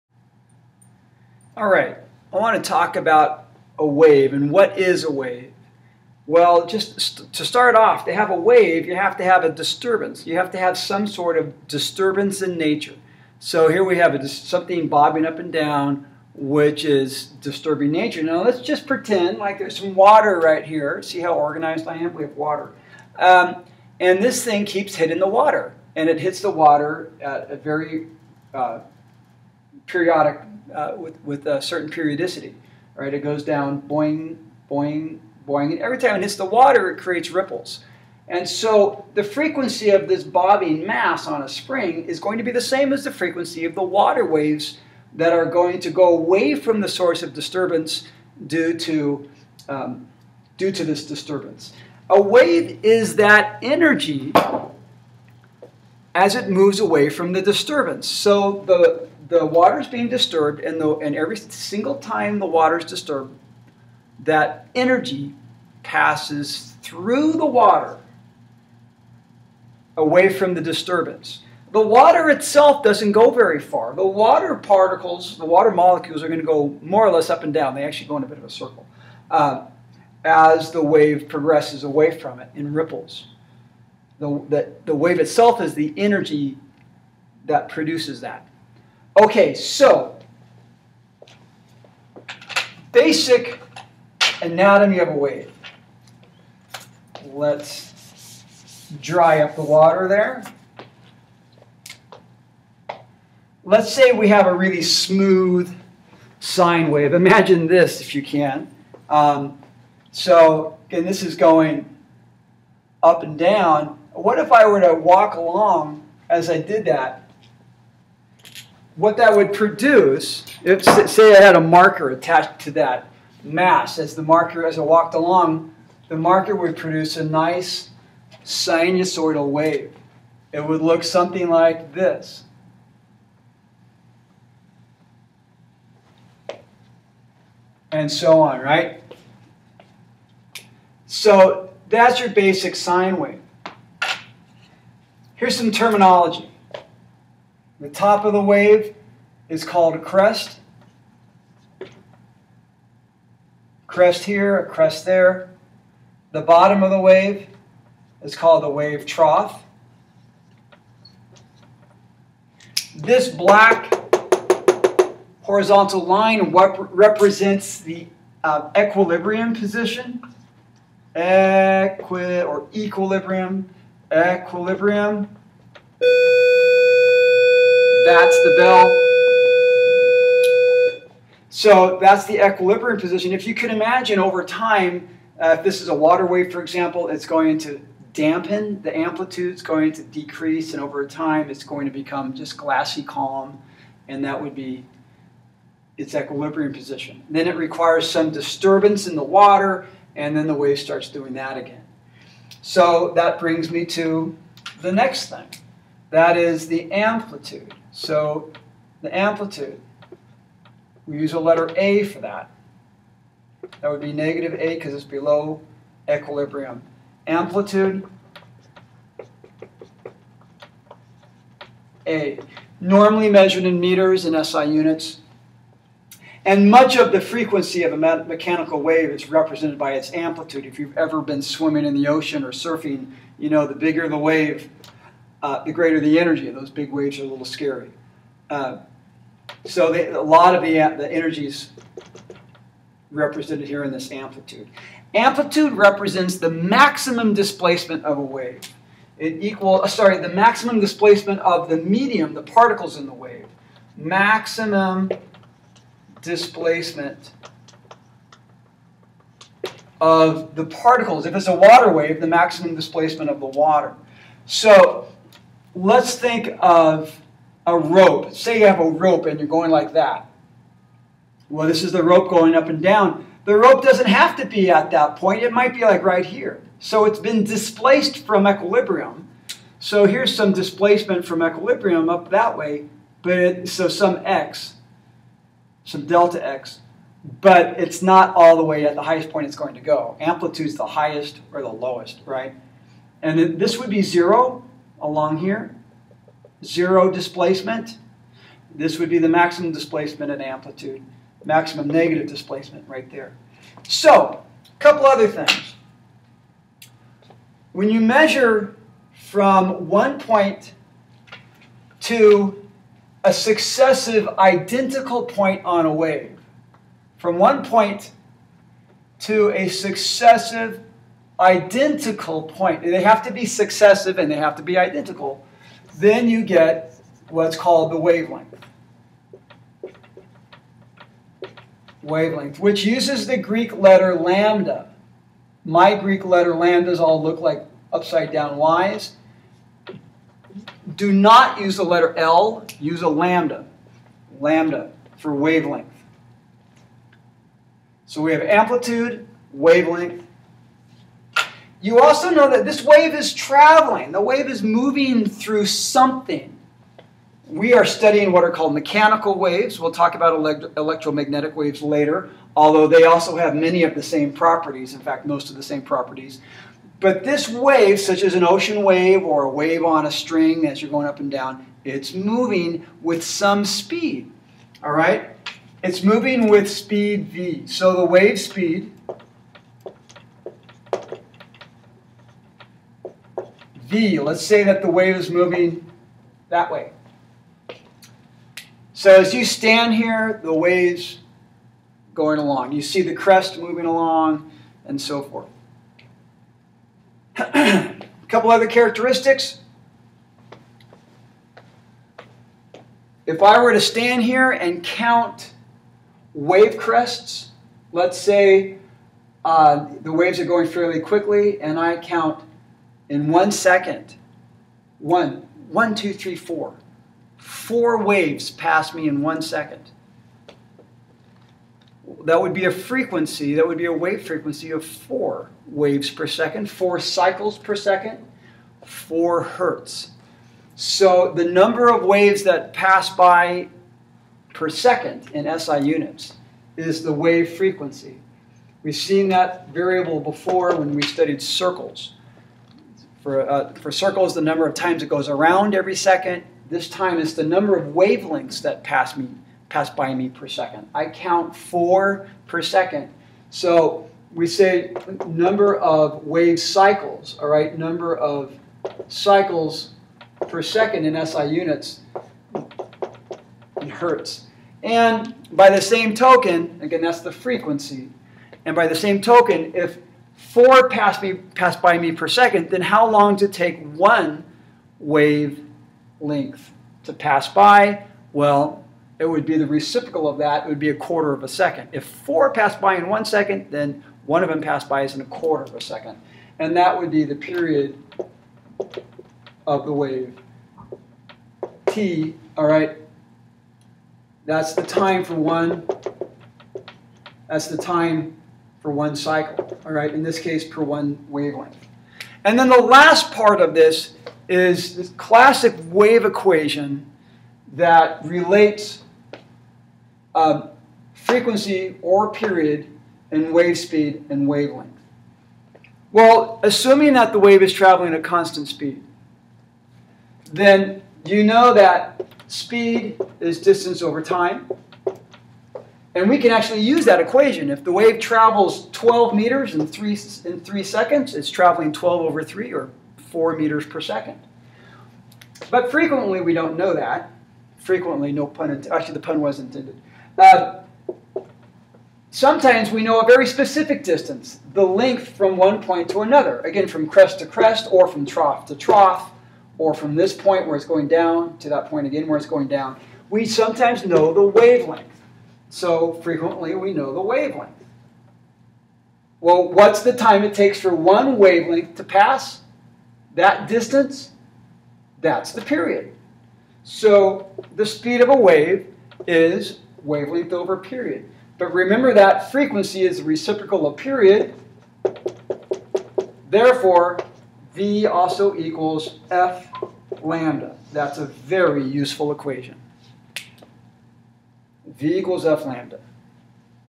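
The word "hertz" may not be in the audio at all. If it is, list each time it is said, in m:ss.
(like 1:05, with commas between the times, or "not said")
7:09, 7:43.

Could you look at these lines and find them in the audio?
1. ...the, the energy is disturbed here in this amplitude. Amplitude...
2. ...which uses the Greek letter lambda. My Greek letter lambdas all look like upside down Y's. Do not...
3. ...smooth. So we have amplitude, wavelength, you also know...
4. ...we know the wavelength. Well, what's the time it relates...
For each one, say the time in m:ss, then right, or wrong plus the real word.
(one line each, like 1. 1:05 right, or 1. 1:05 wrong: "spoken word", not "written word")
1. 4:00 wrong: "represented", not "disturbed"
2. 5:32 right
3. 5:45 wrong: "wavelength", not "smooth"
4. 9:16 wrong: "takes", not "relates".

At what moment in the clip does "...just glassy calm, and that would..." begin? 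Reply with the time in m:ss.
3:12.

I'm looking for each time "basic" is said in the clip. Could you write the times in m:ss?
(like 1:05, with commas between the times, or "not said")
1:32, 2:22.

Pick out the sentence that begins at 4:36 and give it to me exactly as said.
So it's been displaced from equilibrium.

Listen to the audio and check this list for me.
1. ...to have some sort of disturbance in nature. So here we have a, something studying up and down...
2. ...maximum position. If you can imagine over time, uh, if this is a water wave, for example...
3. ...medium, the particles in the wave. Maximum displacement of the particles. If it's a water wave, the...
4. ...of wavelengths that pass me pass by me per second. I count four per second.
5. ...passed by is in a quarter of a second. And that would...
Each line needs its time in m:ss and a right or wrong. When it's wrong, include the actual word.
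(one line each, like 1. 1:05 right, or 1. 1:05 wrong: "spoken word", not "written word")
1. 0:10 wrong: "bobbing", not "studying"
2. 3:02 wrong: "equilibrium", not "maximum"
3. 4:11 right
4. 7:27 right
5. 8:04 right.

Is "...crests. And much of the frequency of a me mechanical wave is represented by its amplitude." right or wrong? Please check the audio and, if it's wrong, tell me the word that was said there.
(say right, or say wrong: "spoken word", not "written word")
wrong: "units", not "crests".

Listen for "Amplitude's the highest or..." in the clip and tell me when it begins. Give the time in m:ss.
4:50.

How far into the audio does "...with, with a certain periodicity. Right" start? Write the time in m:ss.
0:30.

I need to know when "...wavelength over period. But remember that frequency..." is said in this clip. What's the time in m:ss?
9:30.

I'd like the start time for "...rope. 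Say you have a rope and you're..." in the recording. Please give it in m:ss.
4:27.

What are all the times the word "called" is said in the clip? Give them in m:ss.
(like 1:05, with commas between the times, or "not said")
2:29, 2:38, 5:27, 5:58.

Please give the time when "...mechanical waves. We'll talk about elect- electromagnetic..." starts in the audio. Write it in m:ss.
5:58.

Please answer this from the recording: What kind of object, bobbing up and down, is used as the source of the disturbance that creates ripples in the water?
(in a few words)
mass on a spring.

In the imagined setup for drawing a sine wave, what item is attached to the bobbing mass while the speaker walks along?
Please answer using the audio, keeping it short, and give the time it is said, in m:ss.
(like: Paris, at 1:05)
a marker, at 2:01.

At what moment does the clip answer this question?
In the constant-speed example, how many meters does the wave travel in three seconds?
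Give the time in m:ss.
8:48.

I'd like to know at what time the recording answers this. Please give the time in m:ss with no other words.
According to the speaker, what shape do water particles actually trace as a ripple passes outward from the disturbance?
1:18.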